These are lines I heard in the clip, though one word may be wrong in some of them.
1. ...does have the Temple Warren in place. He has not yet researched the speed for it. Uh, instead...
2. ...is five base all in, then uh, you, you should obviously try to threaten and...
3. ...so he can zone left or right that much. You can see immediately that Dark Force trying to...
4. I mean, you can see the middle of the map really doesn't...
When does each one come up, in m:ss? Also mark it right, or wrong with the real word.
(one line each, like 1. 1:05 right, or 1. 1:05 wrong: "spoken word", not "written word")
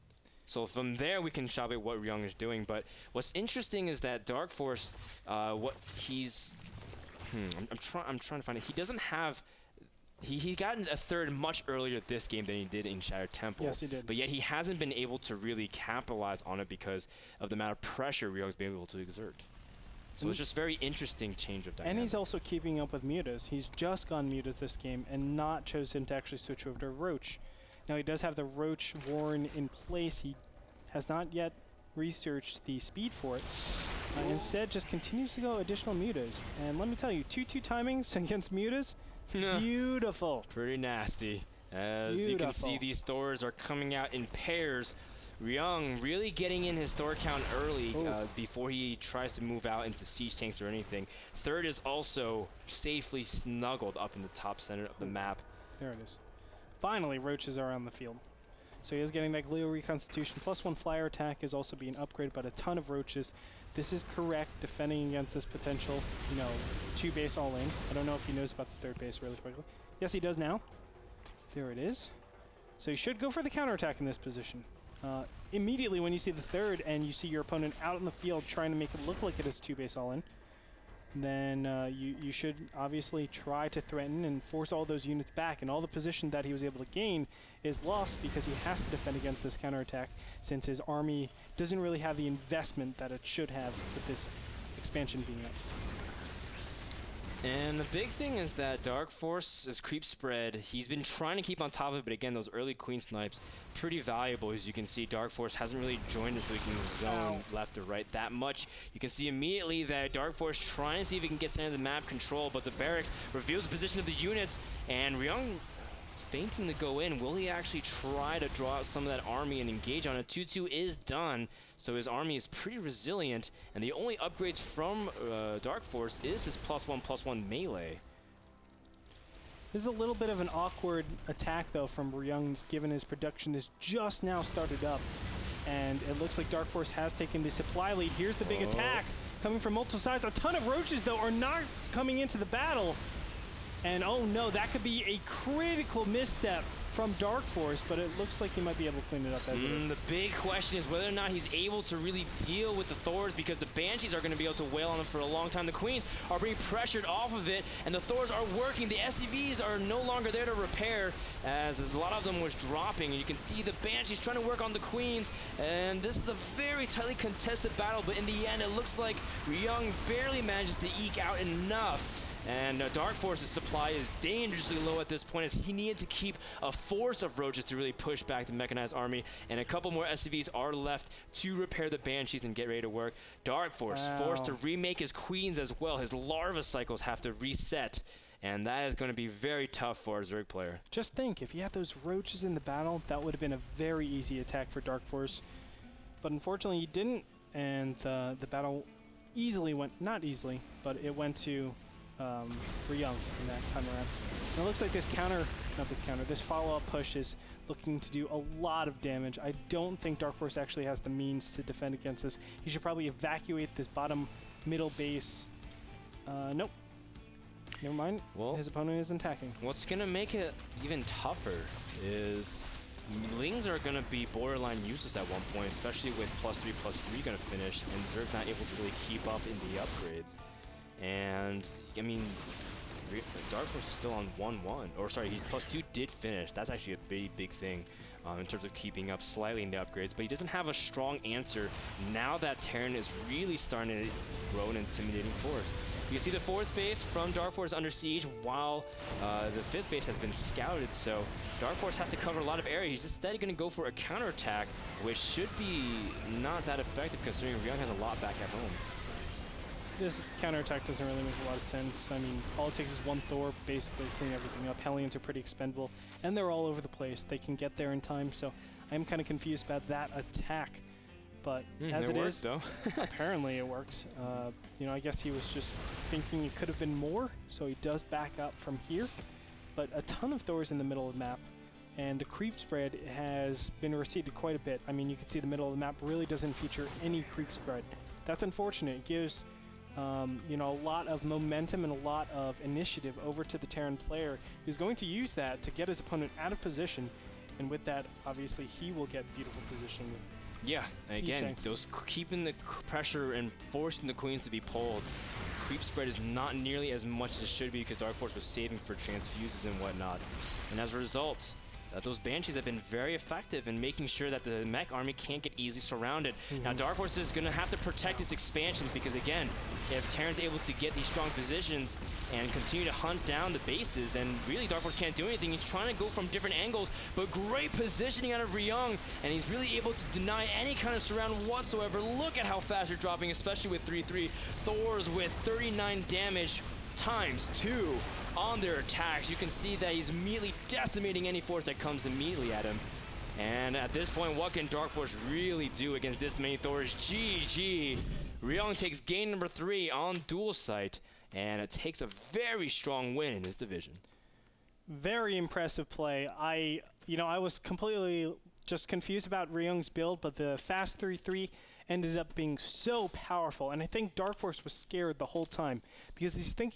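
1. 0:28 wrong: "Roach", not "Temple"
2. 1:19 wrong: "two", not "five"
3. 1:46 right
4. 4:44 right.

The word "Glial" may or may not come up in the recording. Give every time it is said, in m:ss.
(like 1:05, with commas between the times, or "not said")
0:59.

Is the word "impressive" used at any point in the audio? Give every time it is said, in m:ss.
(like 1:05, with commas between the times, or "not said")
5:55.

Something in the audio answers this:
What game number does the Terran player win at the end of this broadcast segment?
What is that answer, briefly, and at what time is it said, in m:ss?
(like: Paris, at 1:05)
3, at 5:49.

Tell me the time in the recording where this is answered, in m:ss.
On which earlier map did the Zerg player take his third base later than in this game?
0:12.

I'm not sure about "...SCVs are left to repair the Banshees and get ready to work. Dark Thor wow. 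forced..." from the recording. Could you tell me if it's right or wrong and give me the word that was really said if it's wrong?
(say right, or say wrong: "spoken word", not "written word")
wrong: "Force", not "Thor".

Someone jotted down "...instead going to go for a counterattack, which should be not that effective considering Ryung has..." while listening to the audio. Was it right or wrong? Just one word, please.
right.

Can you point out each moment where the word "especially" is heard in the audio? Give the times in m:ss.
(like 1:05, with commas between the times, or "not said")
3:45, 5:33.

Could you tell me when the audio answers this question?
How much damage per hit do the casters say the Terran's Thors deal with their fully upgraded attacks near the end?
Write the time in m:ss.
5:35.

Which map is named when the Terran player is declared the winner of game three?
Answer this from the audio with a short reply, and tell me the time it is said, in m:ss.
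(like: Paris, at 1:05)
Dual Sight, at 5:50.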